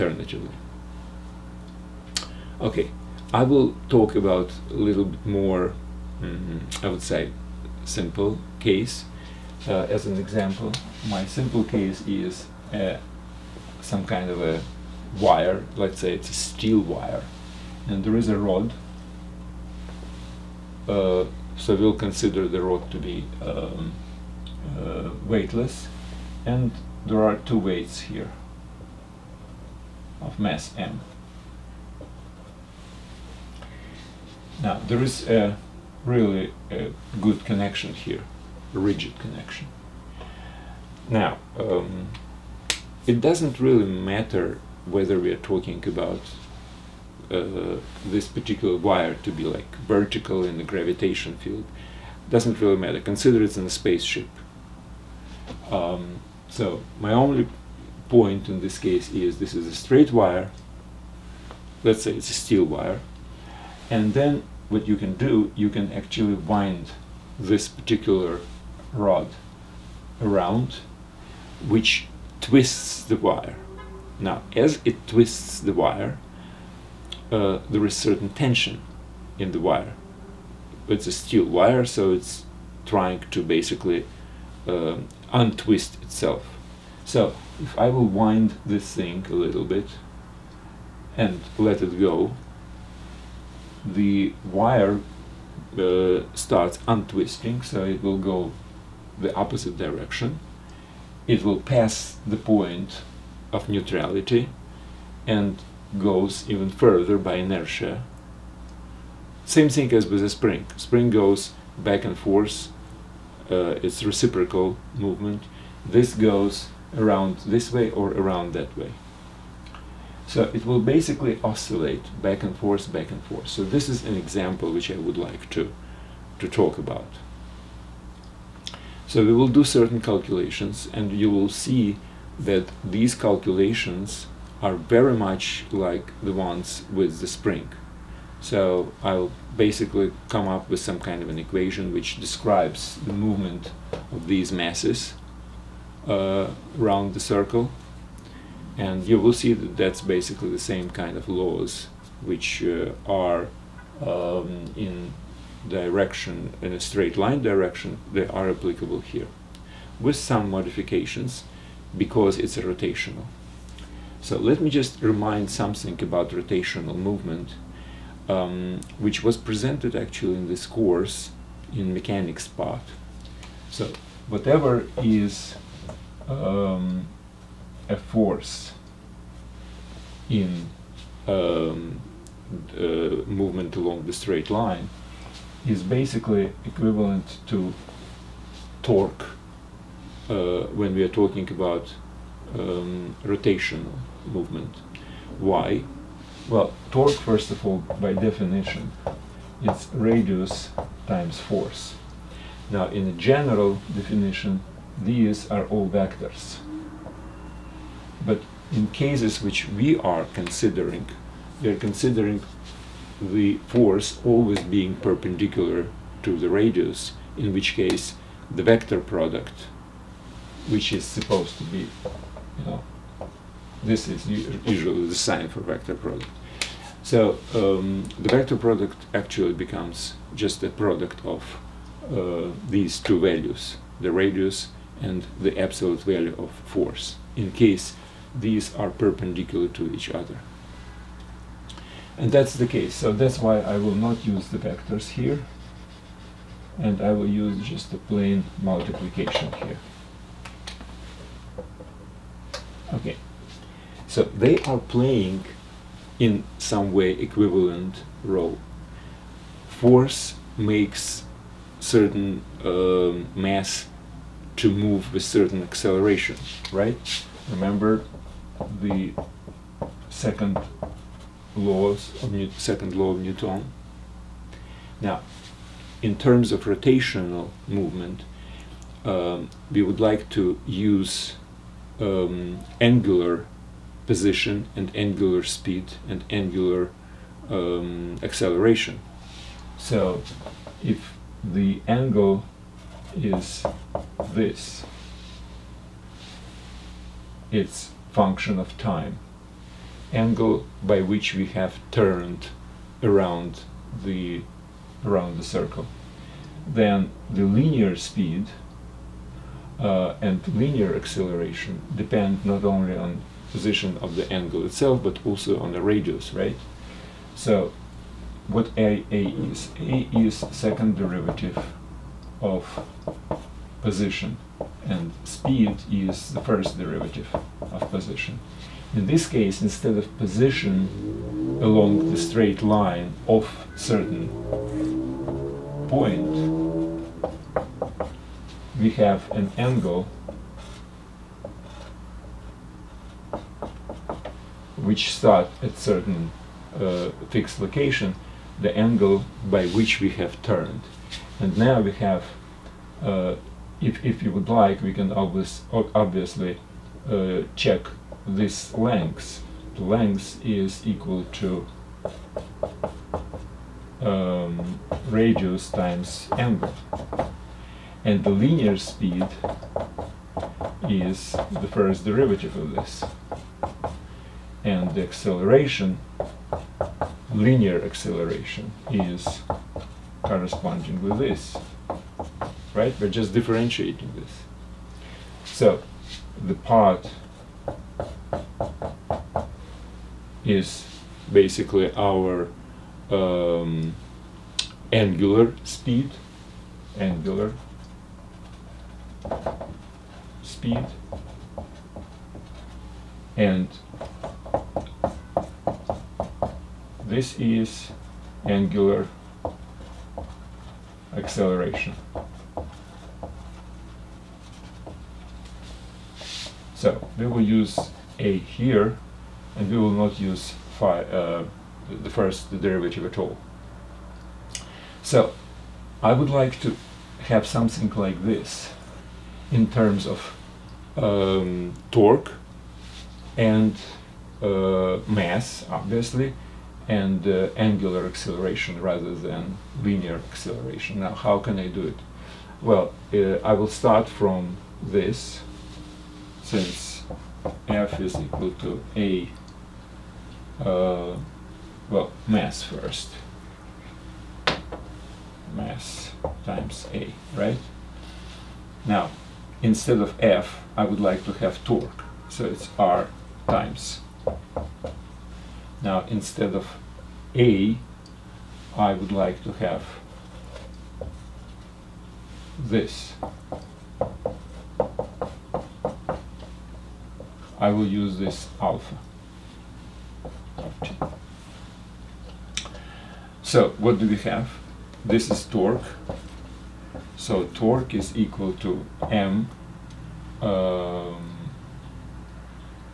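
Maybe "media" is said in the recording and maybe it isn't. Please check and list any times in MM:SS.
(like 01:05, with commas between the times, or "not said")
not said.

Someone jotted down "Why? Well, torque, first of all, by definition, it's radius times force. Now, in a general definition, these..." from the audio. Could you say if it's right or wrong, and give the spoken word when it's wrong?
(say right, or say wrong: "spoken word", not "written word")
right.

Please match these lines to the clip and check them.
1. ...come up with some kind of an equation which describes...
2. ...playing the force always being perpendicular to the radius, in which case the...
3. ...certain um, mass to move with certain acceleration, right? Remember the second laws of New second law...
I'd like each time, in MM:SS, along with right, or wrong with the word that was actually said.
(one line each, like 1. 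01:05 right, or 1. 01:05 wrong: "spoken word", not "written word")
1. 02:20 right
2. 03:31 wrong: "considering", not "playing"
3. 04:21 right.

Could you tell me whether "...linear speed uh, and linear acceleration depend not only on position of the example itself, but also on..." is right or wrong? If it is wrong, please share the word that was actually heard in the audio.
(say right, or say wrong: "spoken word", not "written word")
wrong: "angle", not "example".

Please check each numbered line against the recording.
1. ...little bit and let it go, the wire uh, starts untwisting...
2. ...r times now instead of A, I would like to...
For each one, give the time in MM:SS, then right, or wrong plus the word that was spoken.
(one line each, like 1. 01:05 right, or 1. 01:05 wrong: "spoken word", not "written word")
1. 01:29 right
2. 07:42 right.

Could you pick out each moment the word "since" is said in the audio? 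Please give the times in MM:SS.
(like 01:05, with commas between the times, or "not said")
07:26.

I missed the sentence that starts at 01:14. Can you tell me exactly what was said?
Now, as it twists the wire, uh, there is certain tension in the wire.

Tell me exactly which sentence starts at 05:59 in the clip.
The length is equal to um, radius times angle.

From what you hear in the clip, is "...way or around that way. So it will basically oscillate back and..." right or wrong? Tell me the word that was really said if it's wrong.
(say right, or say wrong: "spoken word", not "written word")
right.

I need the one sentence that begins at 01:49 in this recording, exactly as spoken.
Same thing as with a spring.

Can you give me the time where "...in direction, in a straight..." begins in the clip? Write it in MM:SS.
02:34.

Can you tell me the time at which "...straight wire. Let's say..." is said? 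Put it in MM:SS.
00:59.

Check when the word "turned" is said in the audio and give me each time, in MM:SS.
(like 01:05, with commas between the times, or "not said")
05:01, 05:50.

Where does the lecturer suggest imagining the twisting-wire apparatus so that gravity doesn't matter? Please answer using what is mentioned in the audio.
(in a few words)
in a spaceship.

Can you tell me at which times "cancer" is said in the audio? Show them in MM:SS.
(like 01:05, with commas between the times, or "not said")
not said.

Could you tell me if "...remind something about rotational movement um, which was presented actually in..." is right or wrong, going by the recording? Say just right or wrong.
right.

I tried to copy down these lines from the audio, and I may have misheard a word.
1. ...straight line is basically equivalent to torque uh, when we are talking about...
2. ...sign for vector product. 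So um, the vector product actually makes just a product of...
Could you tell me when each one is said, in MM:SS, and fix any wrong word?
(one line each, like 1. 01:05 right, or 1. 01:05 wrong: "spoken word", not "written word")
1. 03:04 right
2. 03:45 wrong: "becomes", not "makes".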